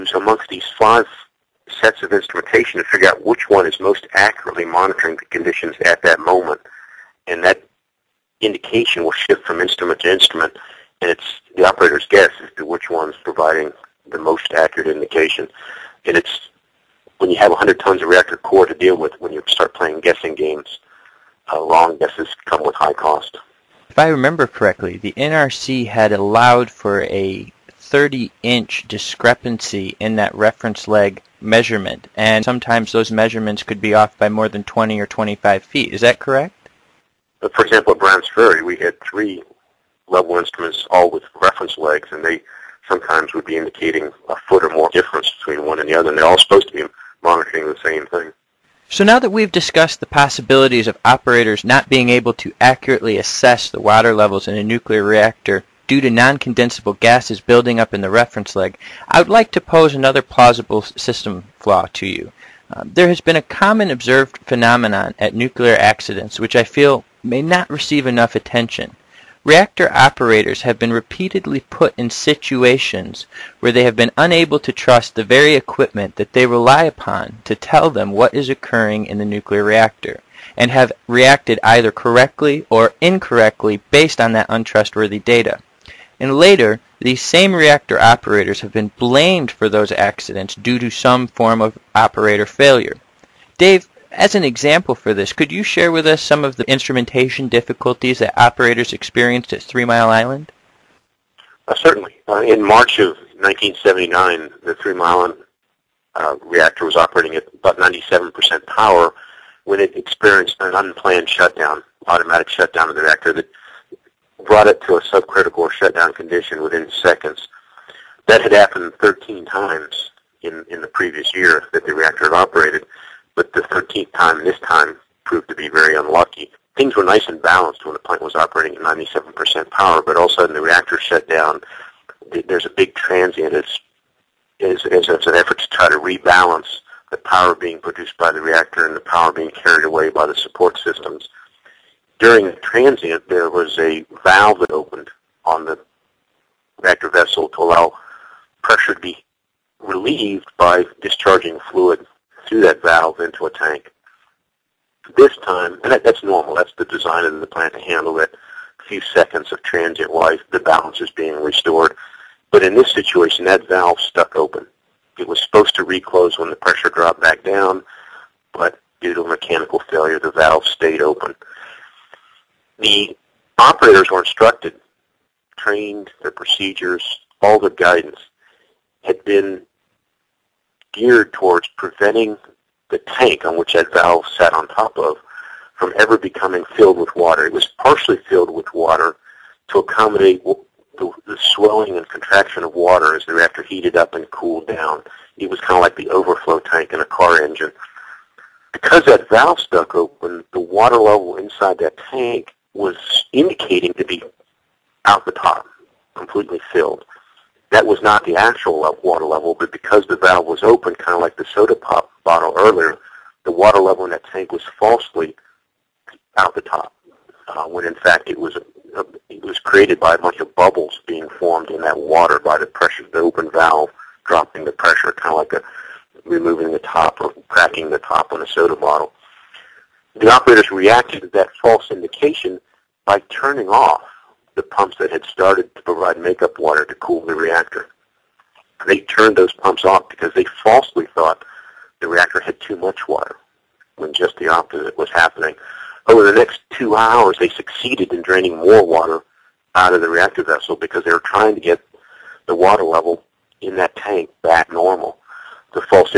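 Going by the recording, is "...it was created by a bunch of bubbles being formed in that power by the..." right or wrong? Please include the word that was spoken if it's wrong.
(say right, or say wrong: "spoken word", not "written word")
wrong: "water", not "power".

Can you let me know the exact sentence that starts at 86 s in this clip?
And later, these same reactor operators have been blamed for those accidents due to some form of operator failure.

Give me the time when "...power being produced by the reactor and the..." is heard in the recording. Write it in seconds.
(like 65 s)
137 s.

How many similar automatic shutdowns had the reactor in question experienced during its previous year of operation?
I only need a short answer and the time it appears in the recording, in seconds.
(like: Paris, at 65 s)
13, at 118 s.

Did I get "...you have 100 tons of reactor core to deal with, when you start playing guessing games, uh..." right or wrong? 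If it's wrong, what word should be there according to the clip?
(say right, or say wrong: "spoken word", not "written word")
right.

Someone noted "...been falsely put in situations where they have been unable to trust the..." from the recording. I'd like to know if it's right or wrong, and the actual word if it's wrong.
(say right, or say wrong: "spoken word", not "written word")
wrong: "repeatedly", not "falsely".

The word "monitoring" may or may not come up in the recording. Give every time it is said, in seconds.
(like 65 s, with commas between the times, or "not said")
4 s, 47 s.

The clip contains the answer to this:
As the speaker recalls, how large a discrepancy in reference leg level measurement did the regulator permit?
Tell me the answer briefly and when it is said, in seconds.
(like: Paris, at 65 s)
30 inches, at 27 s.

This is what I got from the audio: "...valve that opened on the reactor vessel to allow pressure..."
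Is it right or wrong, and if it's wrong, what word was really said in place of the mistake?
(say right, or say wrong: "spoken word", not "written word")
right.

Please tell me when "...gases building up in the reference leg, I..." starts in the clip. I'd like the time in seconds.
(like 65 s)
56 s.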